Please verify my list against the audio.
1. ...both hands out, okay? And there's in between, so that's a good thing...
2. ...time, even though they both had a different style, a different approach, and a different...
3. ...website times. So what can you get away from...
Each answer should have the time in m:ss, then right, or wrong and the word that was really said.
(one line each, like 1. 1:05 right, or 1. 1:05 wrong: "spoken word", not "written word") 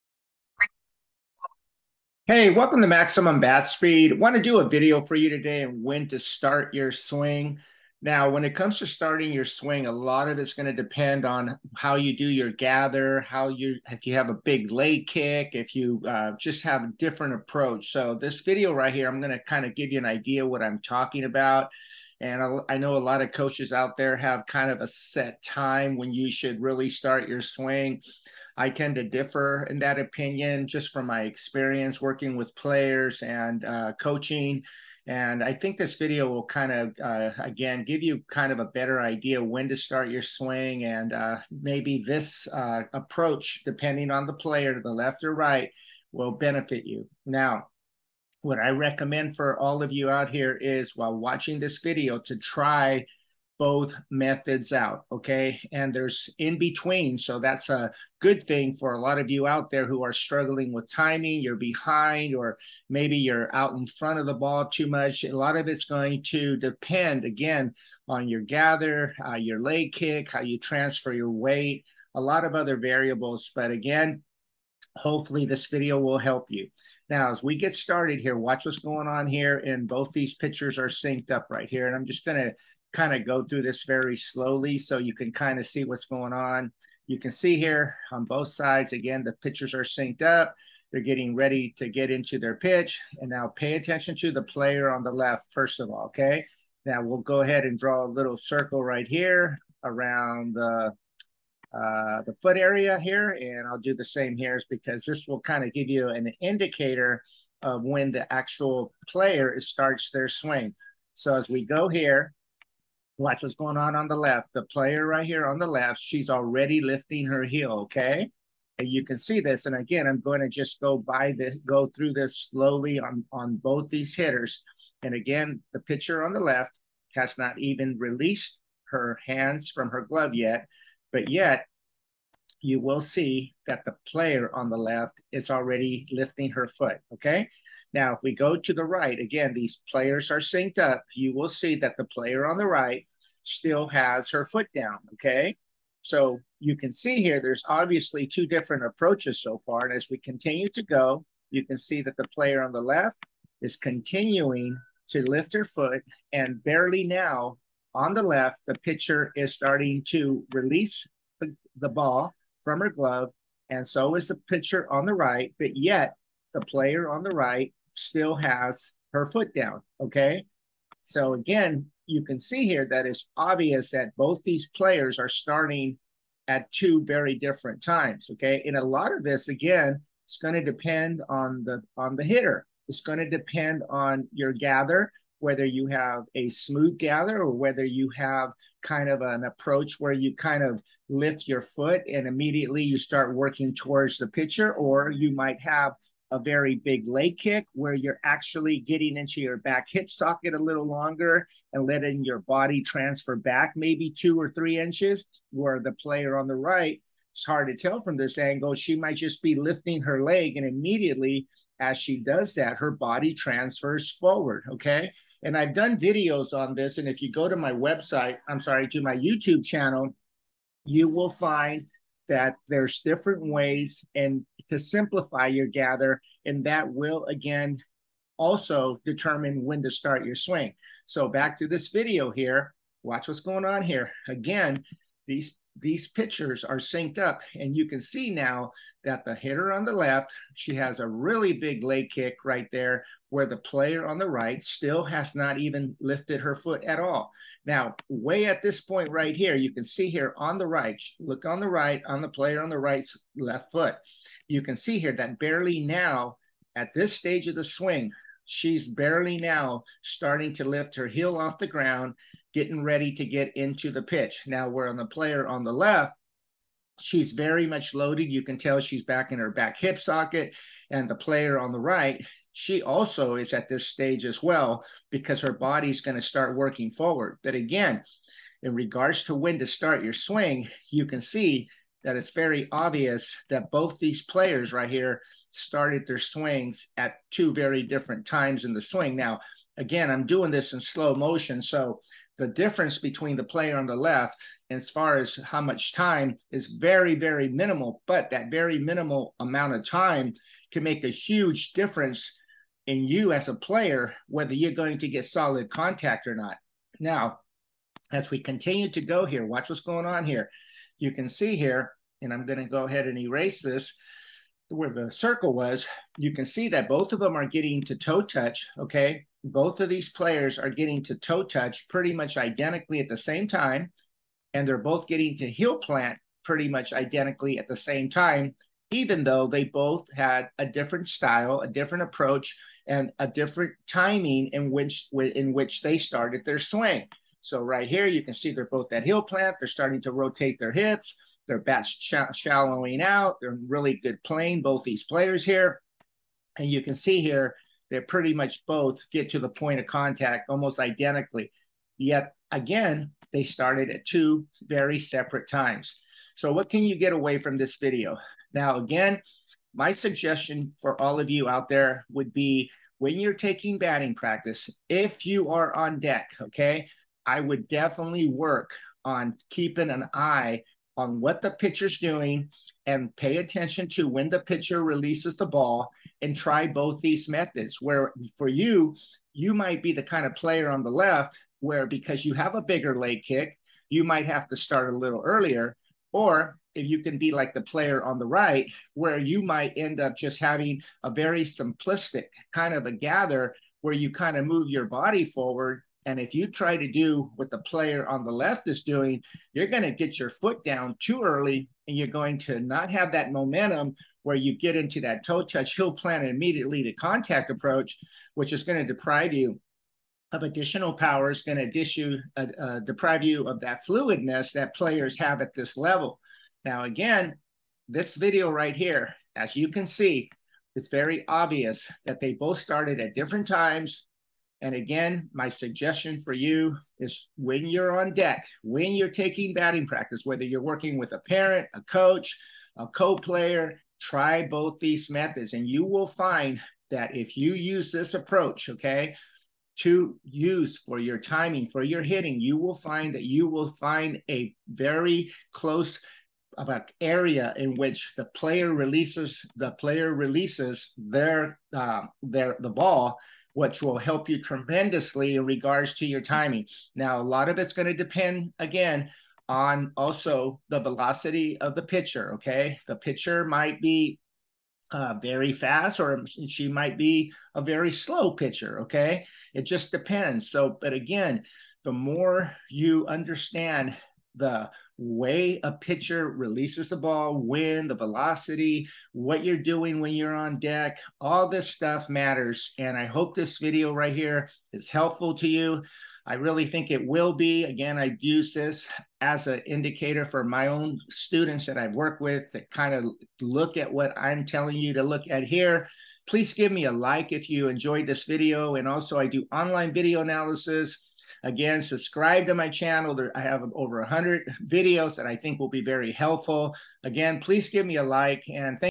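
1. 0:53 wrong: "methods", not "hands"
2. 5:28 right
3. 5:54 wrong: "separate", not "website".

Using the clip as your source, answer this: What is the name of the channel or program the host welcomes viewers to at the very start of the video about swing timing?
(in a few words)
Maximum Bat Speed.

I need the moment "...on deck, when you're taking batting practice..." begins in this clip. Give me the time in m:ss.
7:07.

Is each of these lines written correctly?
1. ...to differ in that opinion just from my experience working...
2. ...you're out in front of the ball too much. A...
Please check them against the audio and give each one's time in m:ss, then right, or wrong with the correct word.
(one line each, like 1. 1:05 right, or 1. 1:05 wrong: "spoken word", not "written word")
1. 0:28 right
2. 1:03 right.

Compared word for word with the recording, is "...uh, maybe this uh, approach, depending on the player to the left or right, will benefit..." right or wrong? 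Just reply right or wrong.
right.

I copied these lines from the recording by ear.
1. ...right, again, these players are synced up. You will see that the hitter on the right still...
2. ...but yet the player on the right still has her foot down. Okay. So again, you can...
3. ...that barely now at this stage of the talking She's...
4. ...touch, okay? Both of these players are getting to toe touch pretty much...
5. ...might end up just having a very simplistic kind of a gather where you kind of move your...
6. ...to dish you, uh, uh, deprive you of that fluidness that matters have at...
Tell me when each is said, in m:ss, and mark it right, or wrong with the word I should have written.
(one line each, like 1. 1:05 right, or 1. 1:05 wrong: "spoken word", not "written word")
1. 2:18 wrong: "player", not "hitter"
2. 2:45 right
3. 4:15 wrong: "swing", not "talking"
4. 5:18 right
5. 6:29 right
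6. 6:51 wrong: "players", not "matters".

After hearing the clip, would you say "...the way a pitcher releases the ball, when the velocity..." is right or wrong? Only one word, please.
right.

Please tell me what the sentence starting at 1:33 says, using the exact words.
And now pay attention to the player on the left, first of all, okay?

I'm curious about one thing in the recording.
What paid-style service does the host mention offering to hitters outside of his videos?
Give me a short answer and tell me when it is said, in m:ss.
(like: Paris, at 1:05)
Online video analysis, at 8:19.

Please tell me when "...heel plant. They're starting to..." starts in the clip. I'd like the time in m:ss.
5:39.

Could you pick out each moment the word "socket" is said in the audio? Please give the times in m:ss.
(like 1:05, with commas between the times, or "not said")
3:20, 4:29.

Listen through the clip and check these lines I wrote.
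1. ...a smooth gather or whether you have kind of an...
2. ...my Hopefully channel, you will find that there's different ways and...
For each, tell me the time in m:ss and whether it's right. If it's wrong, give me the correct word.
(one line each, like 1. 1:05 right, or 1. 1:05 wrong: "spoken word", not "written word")
1. 3:06 right
2. 3:39 wrong: "YouTube", not "Hopefully".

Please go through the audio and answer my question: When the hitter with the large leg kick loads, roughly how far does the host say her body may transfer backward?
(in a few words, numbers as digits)
2 or 3 inches.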